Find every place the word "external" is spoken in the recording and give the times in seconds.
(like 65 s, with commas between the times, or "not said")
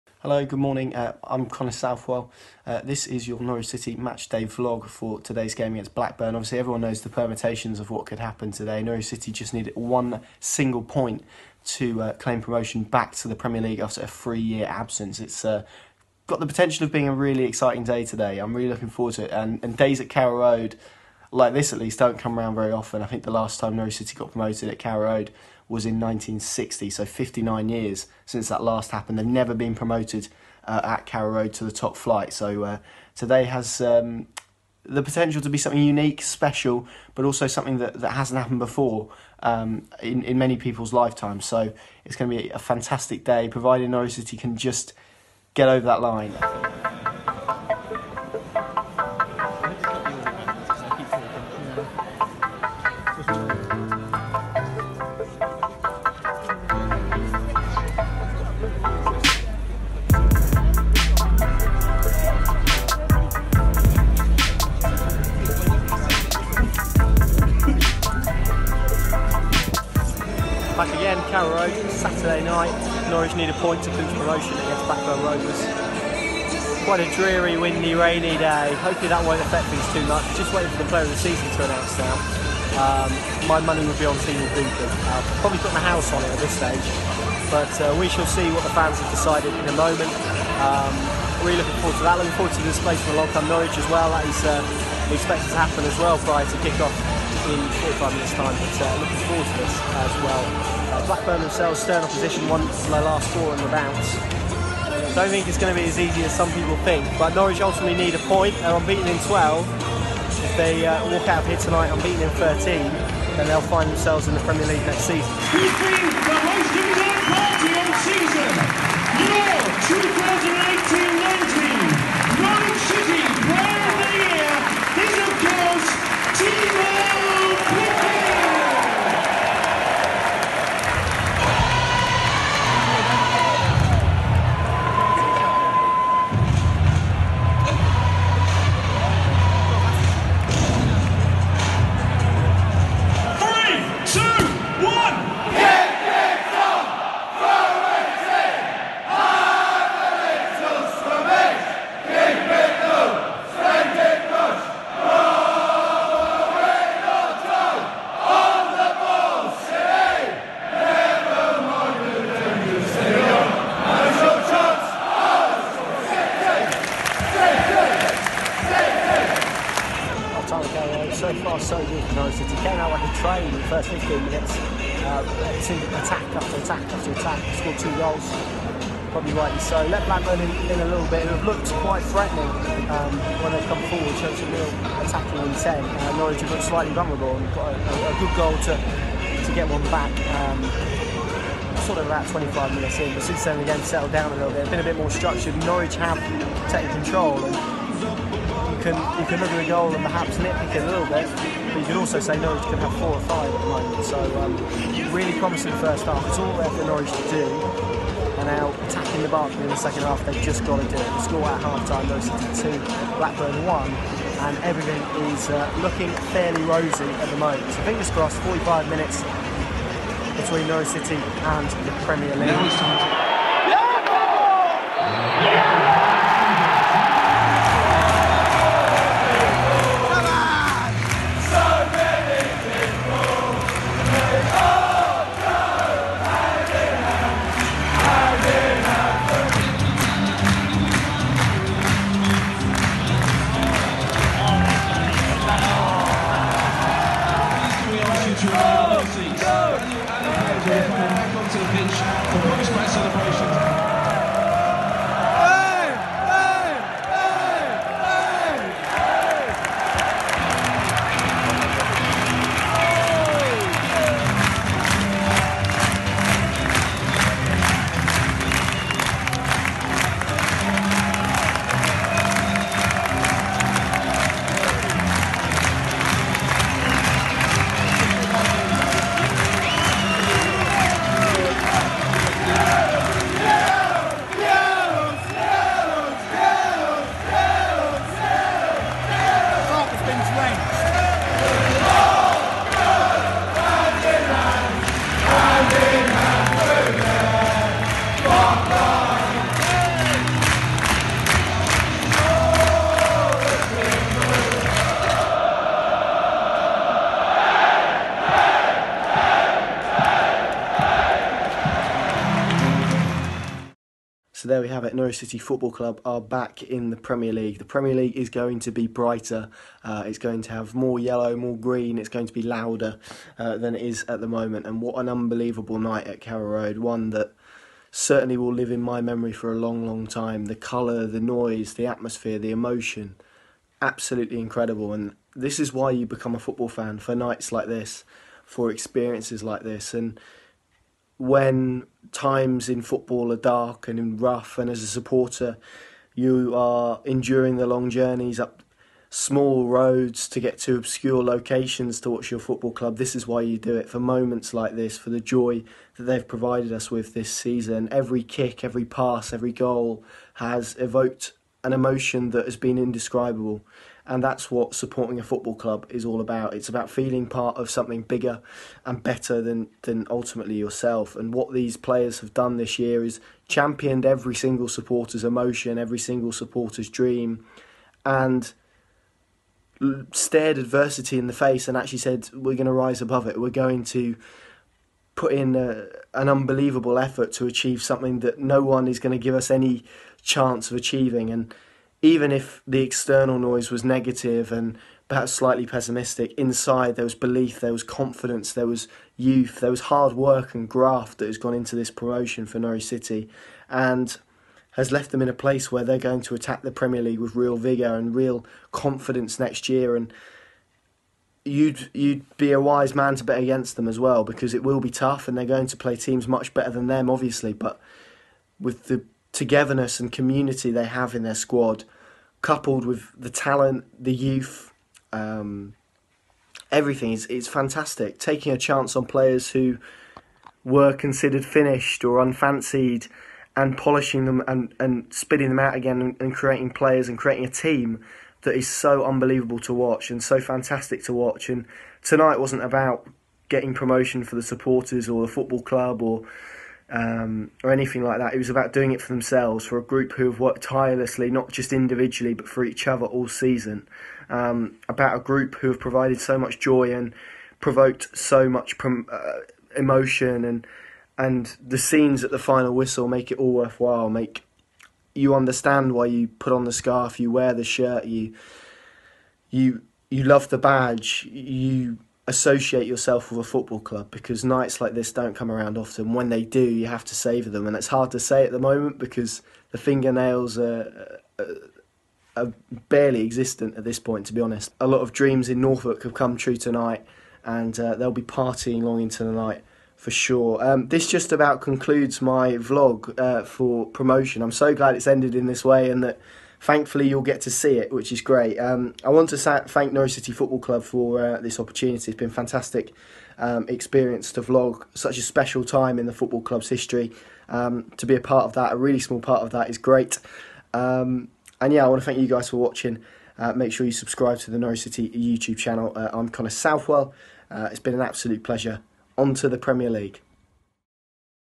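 392 s.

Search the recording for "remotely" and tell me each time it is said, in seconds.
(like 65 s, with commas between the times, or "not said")
not said.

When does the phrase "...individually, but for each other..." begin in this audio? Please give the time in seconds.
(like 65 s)
451 s.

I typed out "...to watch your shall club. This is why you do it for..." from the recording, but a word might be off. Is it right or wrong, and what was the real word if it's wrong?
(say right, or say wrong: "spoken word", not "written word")
wrong: "football", not "shall".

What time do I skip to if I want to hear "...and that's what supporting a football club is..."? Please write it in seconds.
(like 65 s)
364 s.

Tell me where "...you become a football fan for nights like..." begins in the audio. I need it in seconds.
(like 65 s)
335 s.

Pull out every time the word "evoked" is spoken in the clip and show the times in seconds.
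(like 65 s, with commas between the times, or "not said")
360 s.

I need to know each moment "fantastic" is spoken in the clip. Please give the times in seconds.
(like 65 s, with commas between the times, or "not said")
42 s, 427 s, 440 s, 502 s.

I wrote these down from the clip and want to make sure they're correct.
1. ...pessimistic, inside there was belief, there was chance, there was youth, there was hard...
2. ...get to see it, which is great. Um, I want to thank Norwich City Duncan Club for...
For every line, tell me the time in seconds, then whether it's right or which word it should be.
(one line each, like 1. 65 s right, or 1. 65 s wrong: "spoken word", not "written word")
1. 395 s wrong: "confidence", not "chance"
2. 497 s wrong: "Football", not "Duncan".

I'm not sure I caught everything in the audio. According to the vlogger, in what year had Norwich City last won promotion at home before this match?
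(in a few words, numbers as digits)
1960.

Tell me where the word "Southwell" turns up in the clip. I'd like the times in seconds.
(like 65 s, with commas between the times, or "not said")
1 s, 516 s.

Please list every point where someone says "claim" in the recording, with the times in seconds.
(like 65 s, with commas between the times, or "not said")
12 s.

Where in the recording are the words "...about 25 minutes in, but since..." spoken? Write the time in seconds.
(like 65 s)
192 s.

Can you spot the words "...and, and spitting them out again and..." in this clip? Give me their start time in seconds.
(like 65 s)
434 s.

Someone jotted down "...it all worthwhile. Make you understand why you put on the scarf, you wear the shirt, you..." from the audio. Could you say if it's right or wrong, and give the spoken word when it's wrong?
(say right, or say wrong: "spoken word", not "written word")
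right.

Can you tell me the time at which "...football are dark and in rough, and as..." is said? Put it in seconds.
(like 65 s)
342 s.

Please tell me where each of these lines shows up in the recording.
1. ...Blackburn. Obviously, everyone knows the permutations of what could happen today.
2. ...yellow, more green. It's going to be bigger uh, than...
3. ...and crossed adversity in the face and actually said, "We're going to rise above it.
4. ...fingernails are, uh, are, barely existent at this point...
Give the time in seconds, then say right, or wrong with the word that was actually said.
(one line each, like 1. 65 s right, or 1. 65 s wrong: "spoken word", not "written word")
1. 5 s right
2. 320 s wrong: "louder", not "bigger"
3. 378 s wrong: "stared", not "crossed"
4. 479 s right.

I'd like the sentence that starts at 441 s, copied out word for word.
And tonight wasn't about getting promotion for the supporters or the football club or um, or anything like that.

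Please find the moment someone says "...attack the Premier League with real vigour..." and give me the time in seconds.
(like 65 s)
406 s.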